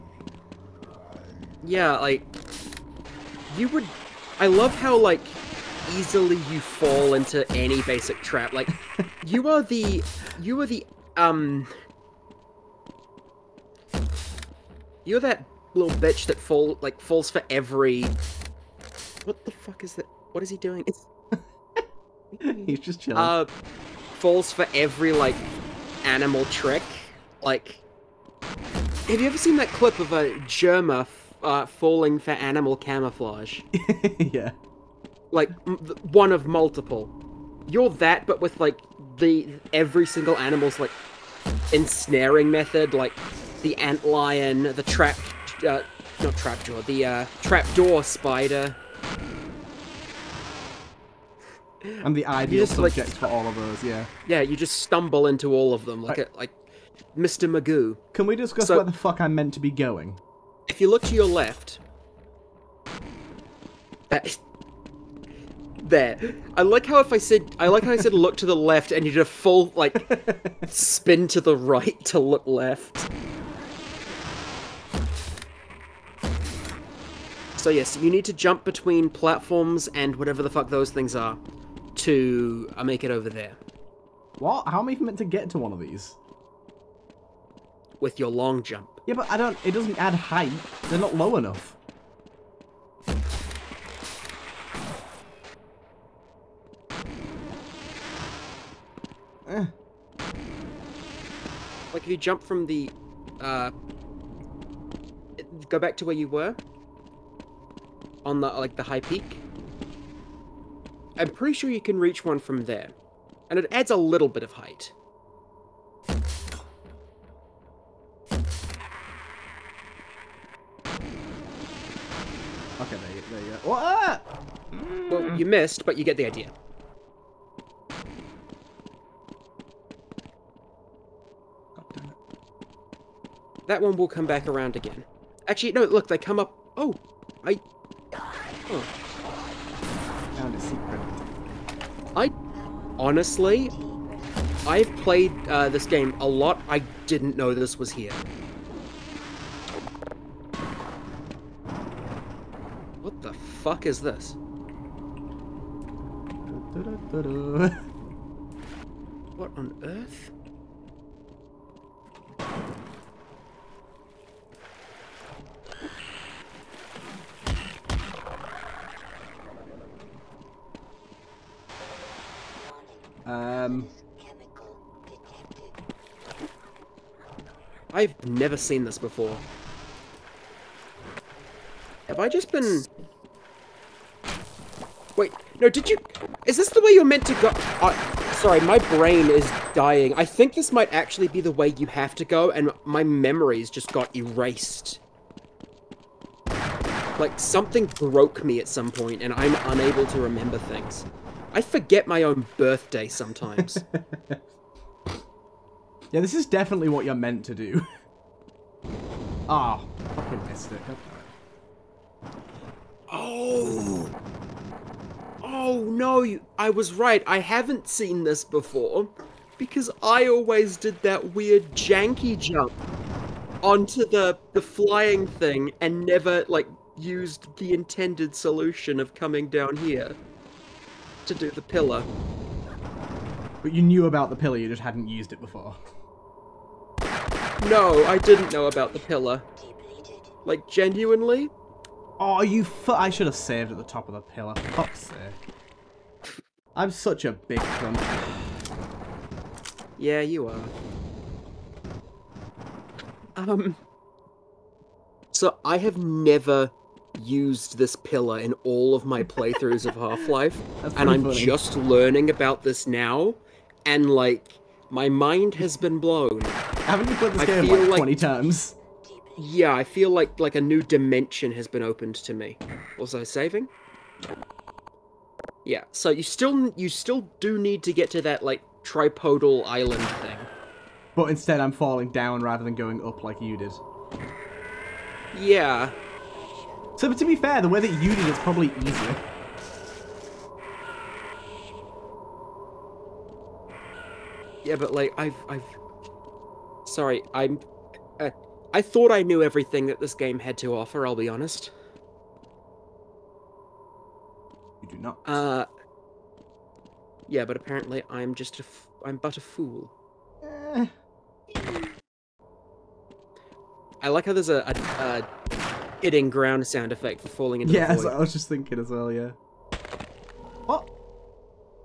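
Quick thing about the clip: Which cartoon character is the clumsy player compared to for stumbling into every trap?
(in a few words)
Mr. Magoo.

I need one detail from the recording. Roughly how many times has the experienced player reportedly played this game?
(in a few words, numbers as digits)
20.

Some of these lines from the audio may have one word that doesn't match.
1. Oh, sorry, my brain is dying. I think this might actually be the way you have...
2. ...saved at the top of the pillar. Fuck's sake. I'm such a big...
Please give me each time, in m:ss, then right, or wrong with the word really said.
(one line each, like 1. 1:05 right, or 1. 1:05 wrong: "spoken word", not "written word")
1. 3:07 right
2. 4:03 right.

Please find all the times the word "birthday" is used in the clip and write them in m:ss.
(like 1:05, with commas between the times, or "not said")
3:22.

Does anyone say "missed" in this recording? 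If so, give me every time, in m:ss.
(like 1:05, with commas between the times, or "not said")
2:05, 3:30.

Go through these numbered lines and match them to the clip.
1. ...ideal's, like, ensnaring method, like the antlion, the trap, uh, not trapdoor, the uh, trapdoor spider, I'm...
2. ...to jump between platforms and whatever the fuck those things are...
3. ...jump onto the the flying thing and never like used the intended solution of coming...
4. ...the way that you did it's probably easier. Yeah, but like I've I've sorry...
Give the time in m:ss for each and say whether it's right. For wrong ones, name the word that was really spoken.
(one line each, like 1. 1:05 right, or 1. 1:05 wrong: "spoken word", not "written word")
1. 0:40 wrong: "animal", not "ideal"
2. 1:18 right
3. 3:42 right
4. 4:47 right.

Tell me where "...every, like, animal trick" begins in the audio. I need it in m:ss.
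0:24.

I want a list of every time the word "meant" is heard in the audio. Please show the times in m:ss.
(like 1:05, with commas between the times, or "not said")
0:59, 1:25, 3:07, 3:27.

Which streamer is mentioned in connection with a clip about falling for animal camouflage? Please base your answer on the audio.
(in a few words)
Jerma.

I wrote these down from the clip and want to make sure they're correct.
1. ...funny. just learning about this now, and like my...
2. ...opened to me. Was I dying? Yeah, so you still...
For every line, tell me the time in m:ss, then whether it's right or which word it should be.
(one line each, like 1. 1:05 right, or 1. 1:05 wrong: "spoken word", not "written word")
1. 4:21 right
2. 4:31 wrong: "saving", not "dying".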